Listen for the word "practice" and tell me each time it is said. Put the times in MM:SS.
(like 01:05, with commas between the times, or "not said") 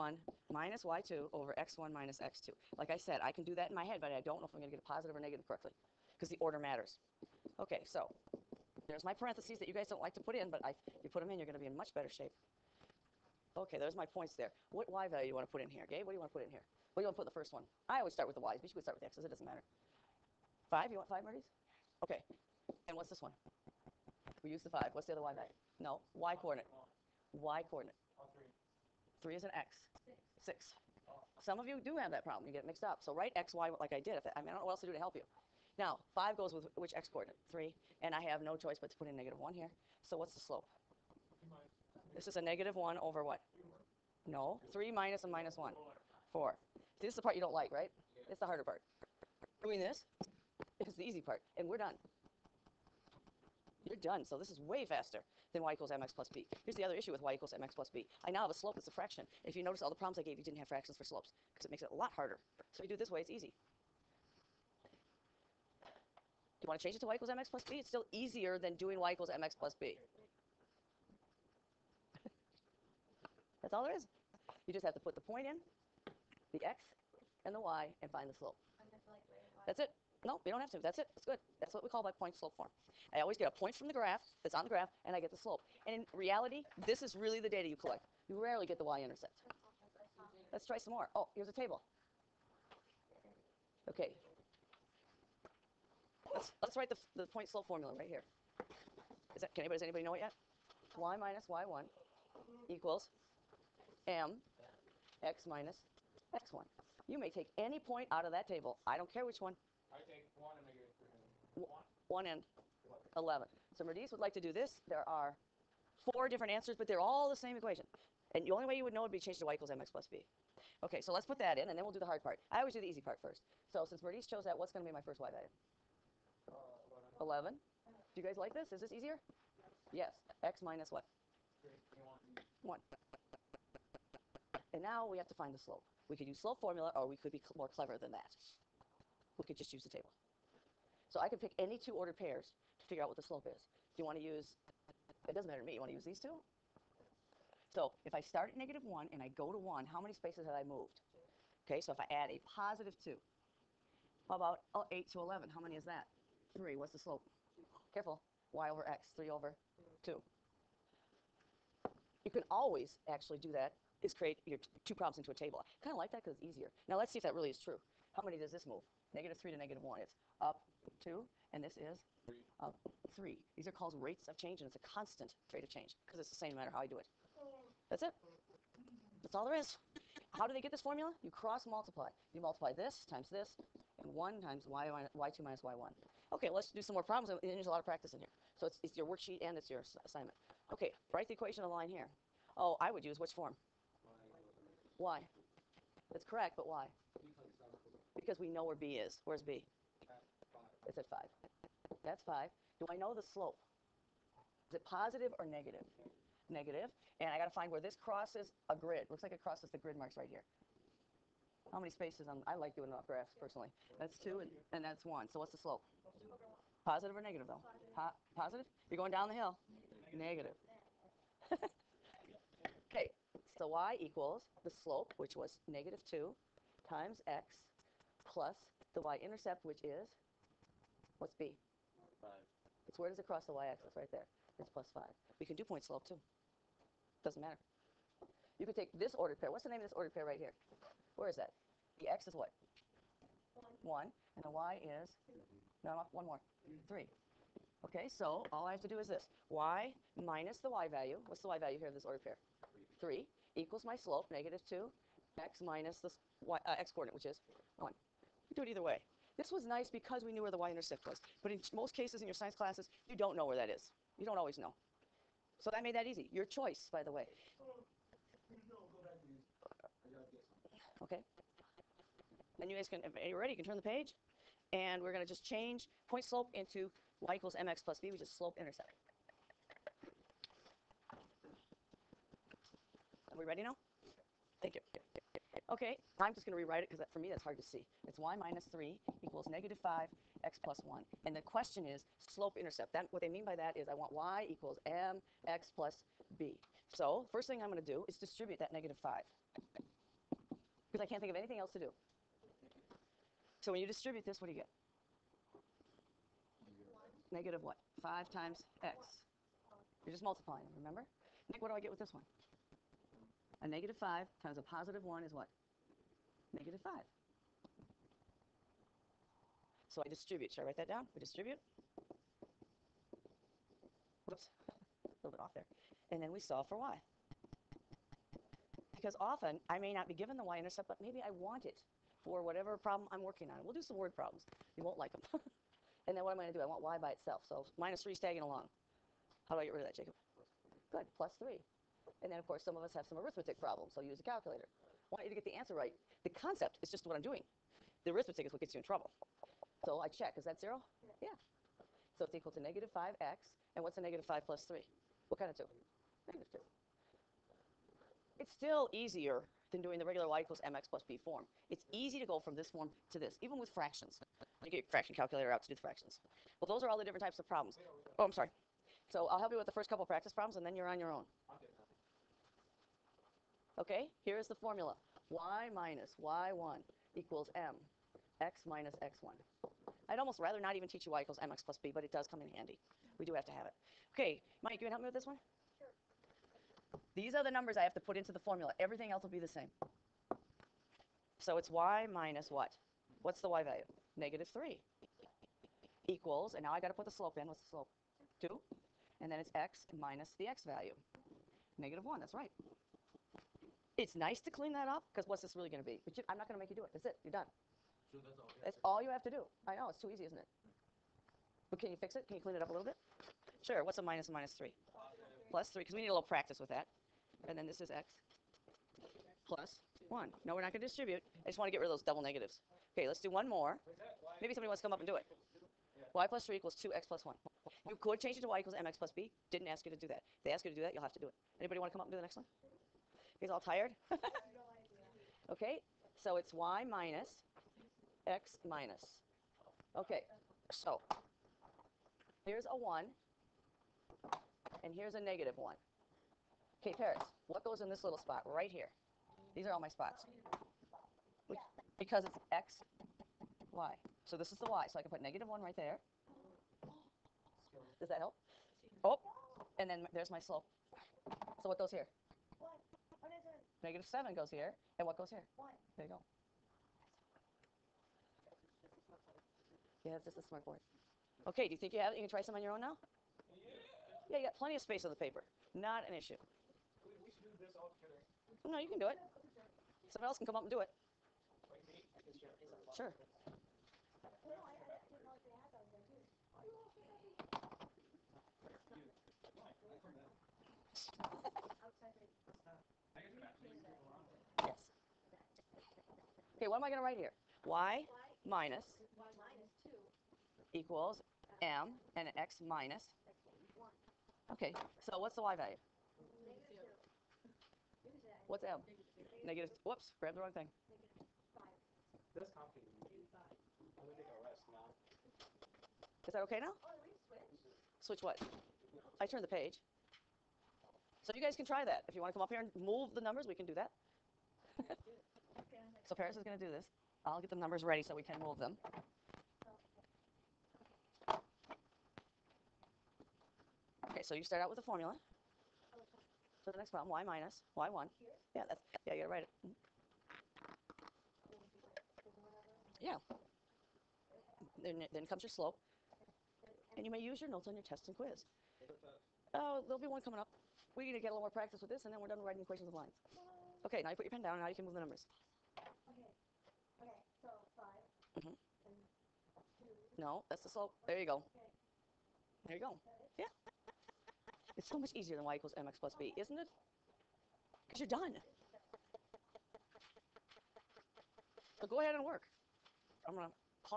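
03:07, 06:10, 06:56, 09:11.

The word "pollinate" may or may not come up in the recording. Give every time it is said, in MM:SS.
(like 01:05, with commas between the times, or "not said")
not said.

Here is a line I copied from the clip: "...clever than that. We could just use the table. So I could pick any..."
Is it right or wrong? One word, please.
right.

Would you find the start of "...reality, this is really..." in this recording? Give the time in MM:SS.
01:26.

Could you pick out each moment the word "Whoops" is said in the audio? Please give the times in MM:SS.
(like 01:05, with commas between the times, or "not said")
05:24, 08:29.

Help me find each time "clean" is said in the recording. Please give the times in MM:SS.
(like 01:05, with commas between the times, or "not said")
06:44, 06:52.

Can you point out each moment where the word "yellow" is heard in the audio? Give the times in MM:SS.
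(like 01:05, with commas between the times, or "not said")
not said.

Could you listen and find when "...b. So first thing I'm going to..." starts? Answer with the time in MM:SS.
04:56.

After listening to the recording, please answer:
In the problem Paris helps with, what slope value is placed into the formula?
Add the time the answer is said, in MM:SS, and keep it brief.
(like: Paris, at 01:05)
-7, at 07:43.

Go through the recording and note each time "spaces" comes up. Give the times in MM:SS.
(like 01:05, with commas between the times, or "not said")
02:30, 03:31, 07:54.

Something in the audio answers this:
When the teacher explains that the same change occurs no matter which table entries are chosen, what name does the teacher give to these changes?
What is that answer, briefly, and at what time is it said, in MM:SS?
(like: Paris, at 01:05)
rates of change, at 02:53.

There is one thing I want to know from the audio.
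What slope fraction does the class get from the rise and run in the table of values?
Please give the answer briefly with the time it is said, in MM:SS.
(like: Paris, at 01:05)
3/2, at 02:39.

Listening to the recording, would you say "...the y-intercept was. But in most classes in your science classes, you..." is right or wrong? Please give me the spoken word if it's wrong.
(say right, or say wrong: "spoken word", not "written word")
wrong: "cases", not "classes".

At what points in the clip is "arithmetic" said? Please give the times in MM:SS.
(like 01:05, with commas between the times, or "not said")
05:43, 05:48.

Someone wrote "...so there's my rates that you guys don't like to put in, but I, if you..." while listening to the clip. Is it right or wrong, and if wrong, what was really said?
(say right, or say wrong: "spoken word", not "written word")
wrong: "parentheses", not "rates".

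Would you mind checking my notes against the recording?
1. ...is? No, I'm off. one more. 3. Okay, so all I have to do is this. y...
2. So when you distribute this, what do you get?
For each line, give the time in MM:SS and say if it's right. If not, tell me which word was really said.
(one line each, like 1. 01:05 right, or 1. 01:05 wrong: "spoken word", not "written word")
1. 04:04 right
2. 05:03 right.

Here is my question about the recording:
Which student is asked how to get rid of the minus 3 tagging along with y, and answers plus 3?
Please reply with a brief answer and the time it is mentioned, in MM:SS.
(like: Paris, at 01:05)
Jacob, at 05:39.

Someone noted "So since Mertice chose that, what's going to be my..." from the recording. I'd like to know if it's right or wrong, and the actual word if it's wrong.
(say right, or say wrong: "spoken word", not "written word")
right.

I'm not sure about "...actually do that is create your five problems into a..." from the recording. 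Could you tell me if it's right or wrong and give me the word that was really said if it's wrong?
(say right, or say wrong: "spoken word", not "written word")
wrong: "two", not "five".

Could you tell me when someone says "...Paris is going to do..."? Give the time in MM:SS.
08:46.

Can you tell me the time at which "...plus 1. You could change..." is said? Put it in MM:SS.
07:07.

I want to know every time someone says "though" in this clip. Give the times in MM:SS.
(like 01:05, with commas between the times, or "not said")
03:37.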